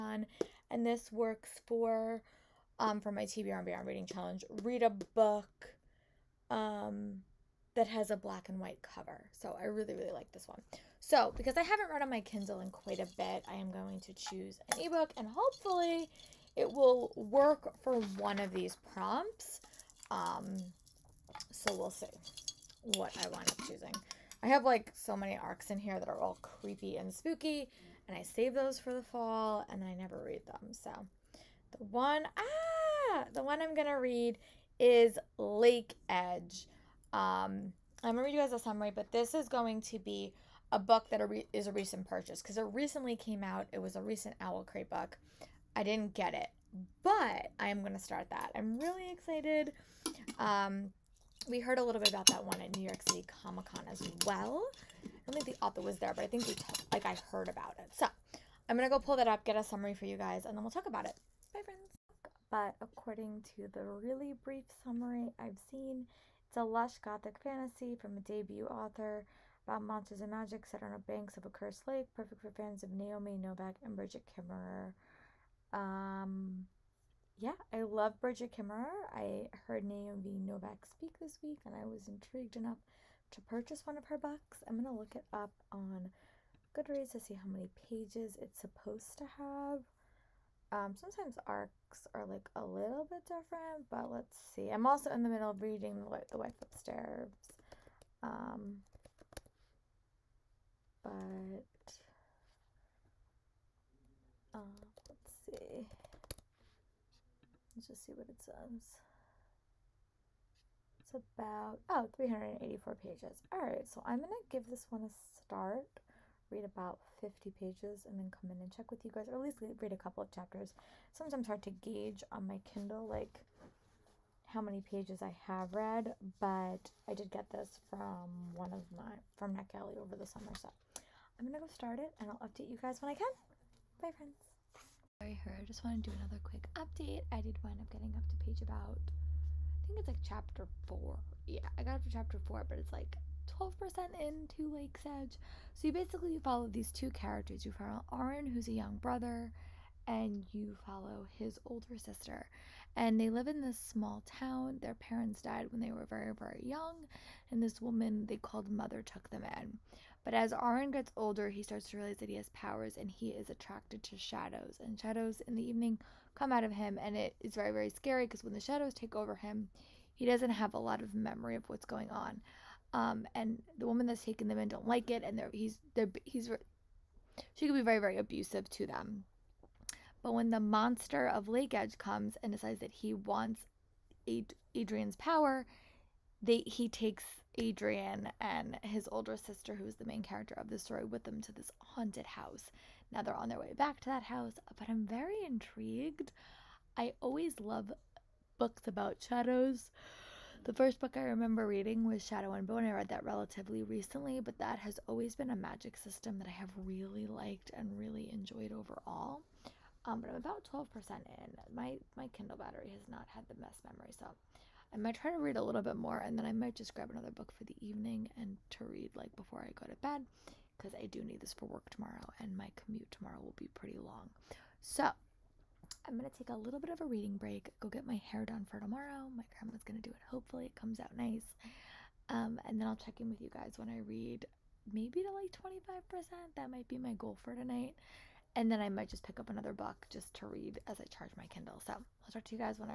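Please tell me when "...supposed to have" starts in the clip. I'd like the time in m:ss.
1:28.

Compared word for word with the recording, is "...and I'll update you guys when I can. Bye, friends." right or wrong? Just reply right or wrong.
right.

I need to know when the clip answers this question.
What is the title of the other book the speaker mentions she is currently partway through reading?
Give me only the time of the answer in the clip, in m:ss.
1:36.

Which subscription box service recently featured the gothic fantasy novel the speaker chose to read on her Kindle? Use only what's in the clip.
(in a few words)
Owl Crate.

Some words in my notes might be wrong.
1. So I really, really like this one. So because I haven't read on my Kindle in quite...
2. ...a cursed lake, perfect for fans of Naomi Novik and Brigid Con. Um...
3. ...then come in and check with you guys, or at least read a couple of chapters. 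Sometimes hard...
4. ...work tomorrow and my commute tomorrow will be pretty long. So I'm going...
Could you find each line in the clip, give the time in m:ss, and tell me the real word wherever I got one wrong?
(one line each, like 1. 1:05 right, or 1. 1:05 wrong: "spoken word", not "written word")
1. 0:09 right
2. 1:11 wrong: "Kemmerer", not "Con"
3. 1:58 right
4. 3:41 right.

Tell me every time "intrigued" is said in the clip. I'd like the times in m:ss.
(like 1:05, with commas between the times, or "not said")
1:22, 3:15.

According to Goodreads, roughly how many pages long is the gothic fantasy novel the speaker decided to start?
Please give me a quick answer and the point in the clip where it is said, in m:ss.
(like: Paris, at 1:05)
384, at 1:52.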